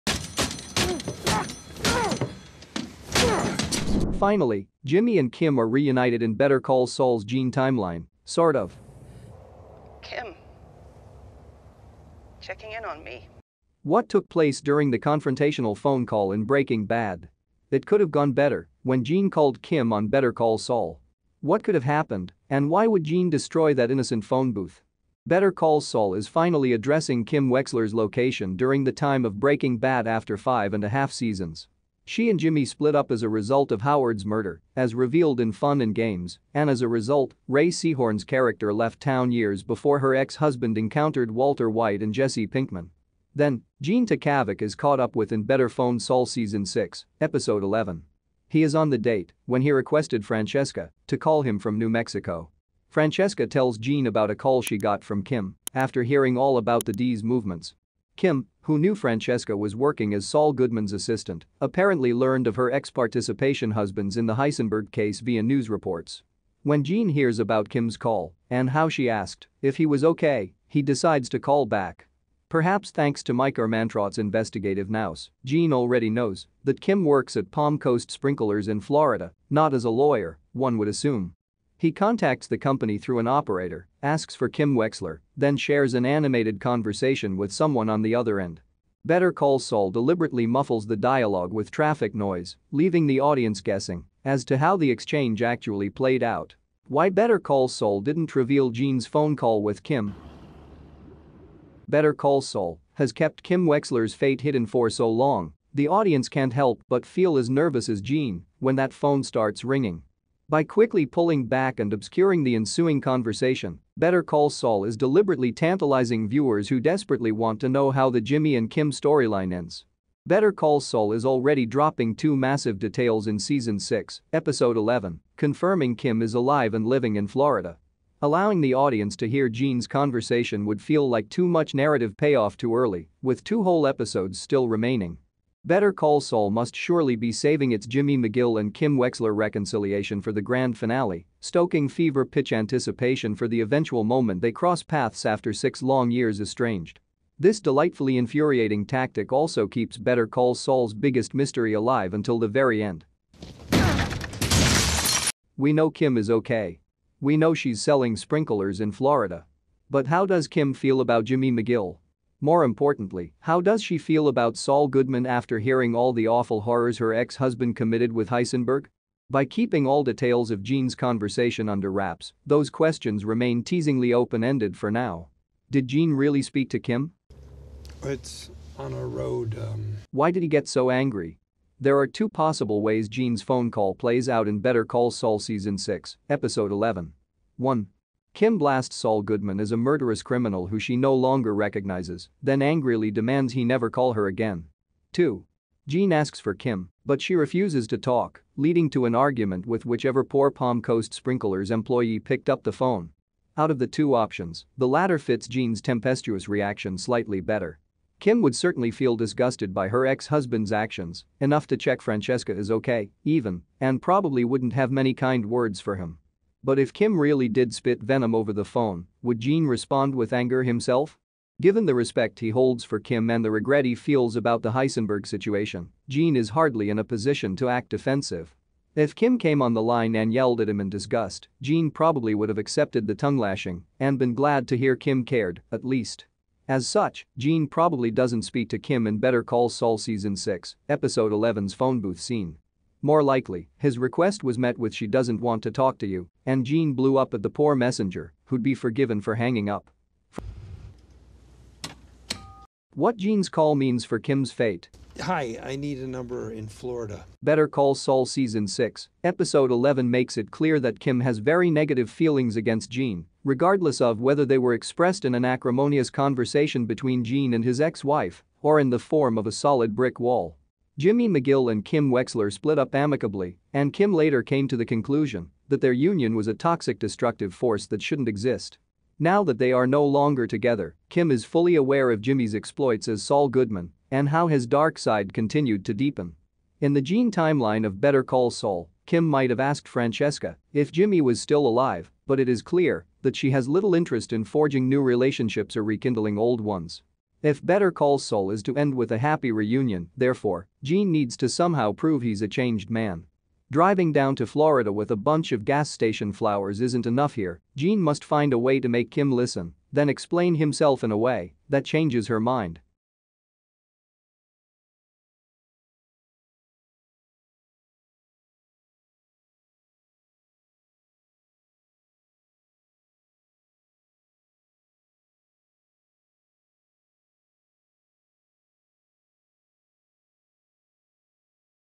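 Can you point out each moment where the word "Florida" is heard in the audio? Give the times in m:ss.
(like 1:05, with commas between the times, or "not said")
1:18, 2:07, 2:38, 4:16, 5:04.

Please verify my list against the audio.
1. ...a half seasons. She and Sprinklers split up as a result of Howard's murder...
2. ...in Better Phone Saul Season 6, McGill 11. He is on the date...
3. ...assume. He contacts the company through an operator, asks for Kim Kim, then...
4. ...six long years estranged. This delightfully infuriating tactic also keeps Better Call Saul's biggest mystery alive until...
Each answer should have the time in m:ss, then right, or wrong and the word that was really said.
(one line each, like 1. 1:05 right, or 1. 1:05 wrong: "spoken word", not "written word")
1. 0:30 wrong: "Jimmy", not "Sprinklers"
2. 0:45 wrong: "Episode", not "McGill"
3. 1:20 wrong: "Wexler", not "Kim"
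4. 2:25 right.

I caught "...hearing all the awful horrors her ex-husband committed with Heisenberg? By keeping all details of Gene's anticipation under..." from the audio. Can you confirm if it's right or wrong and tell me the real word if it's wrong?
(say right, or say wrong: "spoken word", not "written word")
wrong: "conversation", not "anticipation".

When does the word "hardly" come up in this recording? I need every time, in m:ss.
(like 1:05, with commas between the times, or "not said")
3:46.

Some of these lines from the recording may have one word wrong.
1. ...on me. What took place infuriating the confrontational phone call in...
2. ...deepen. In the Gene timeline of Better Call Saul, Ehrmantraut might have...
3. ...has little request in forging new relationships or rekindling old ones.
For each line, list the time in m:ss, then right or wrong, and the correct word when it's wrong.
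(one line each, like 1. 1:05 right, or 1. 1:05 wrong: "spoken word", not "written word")
1. 0:12 wrong: "during", not "infuriating"
2. 4:45 wrong: "Kim", not "Ehrmantraut"
3. 4:53 wrong: "interest", not "request".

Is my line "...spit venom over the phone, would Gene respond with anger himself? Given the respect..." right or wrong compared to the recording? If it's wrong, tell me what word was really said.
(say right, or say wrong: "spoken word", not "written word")
right.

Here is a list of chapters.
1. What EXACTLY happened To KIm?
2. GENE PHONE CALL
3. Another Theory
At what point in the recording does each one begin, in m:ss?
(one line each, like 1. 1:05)
1. 4:10
2. 1:36
3. 2:55.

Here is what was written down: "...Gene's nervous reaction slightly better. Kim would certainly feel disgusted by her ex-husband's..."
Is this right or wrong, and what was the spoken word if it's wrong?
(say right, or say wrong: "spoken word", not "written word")
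wrong: "tempestuous", not "nervous".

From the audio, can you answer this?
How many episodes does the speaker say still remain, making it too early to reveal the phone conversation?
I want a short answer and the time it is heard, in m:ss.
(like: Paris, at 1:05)
2, at 2:13.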